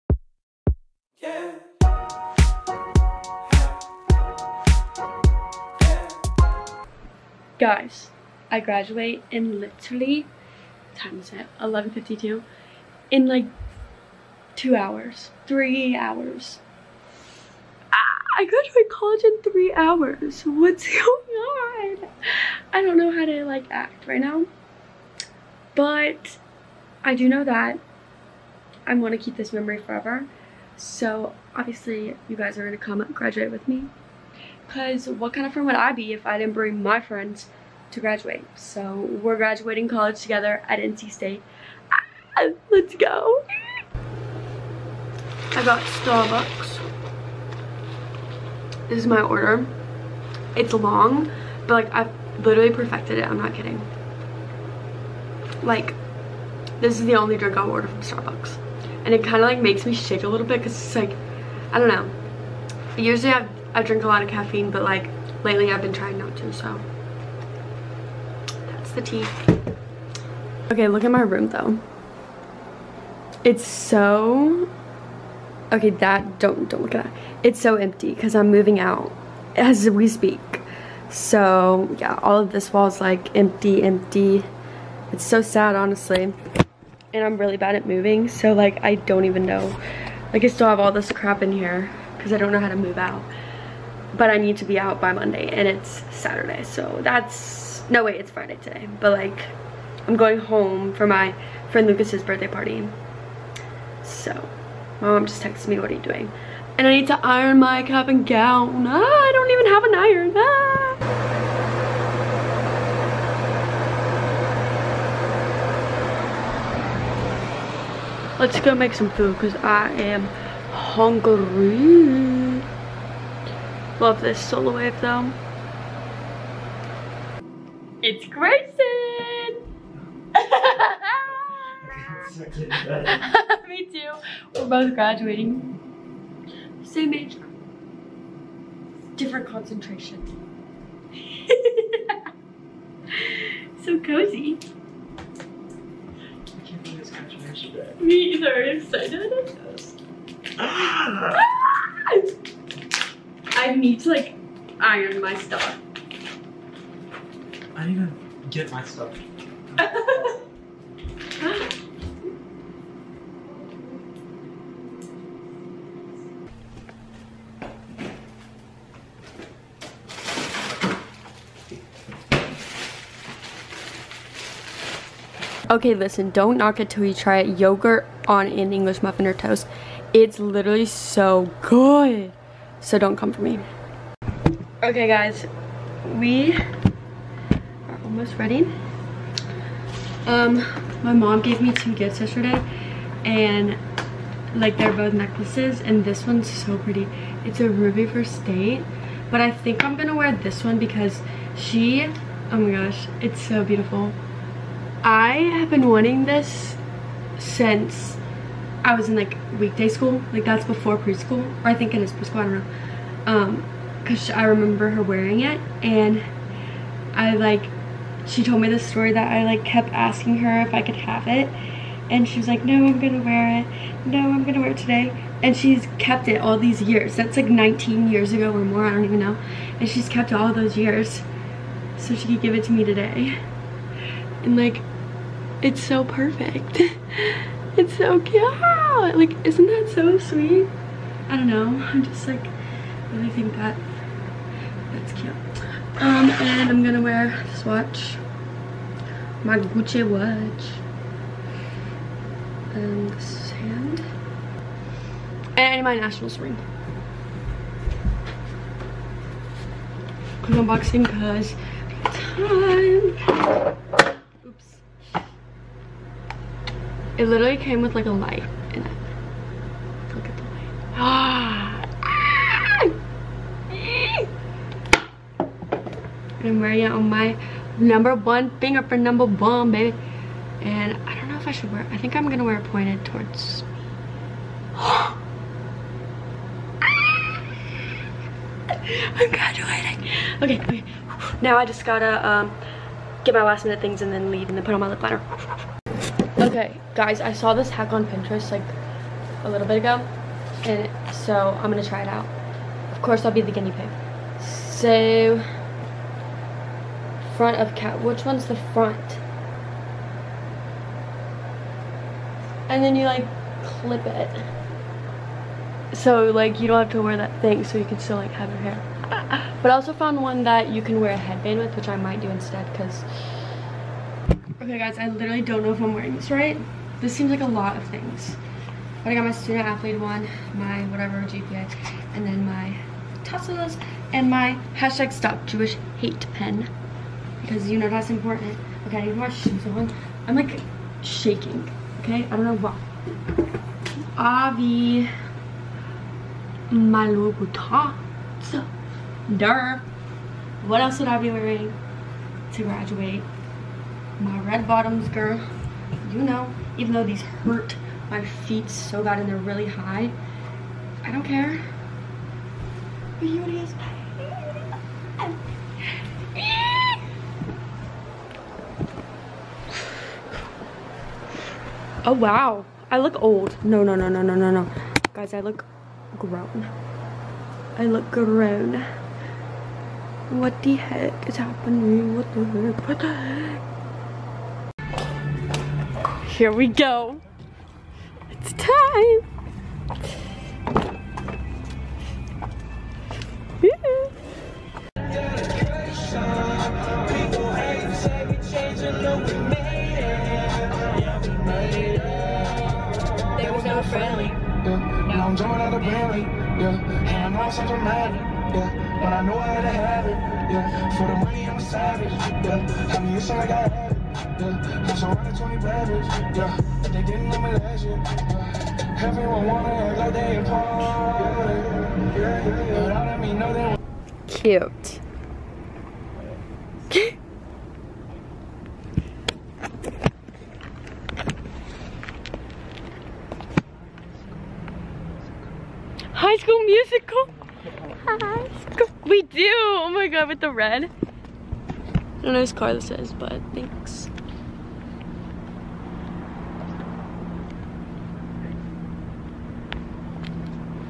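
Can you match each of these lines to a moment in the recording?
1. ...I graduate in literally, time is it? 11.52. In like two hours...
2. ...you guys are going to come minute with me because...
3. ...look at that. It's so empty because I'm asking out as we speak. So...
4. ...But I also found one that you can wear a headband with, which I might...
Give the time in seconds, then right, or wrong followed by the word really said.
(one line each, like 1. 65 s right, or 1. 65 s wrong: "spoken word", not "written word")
1. 8 s right
2. 32 s wrong: "graduate", not "minute"
3. 76 s wrong: "moving", not "asking"
4. 319 s right.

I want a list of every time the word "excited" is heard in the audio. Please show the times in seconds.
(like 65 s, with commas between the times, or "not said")
148 s.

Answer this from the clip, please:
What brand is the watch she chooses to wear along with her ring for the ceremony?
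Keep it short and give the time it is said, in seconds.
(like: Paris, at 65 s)
Gucci, at 249 s.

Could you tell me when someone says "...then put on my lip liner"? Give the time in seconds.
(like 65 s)
294 s.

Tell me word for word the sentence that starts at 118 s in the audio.
Let's go make some food because I am hungry.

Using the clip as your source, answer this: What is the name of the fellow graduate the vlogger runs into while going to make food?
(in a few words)
Grayson.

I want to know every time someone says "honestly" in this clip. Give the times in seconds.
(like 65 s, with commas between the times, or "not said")
85 s.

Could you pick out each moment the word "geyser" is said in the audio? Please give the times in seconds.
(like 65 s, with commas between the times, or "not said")
not said.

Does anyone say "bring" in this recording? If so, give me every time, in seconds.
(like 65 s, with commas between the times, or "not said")
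36 s.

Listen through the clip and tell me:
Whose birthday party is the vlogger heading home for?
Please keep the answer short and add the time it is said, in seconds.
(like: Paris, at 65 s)
Lucas, at 101 s.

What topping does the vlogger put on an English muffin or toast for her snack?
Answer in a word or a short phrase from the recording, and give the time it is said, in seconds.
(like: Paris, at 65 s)
Yogurt, at 177 s.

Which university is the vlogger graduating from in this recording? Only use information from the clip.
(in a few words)
NC State.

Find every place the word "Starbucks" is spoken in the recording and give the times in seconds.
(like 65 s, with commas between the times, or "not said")
45 s, 58 s.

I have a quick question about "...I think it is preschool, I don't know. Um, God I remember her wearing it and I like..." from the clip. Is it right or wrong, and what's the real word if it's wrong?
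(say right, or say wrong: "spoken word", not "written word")
wrong: "Cause", not "God".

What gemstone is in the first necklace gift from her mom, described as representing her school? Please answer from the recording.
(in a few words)
Ruby.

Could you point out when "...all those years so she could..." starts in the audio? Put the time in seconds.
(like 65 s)
230 s.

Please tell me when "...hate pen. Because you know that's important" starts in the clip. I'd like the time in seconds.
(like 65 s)
335 s.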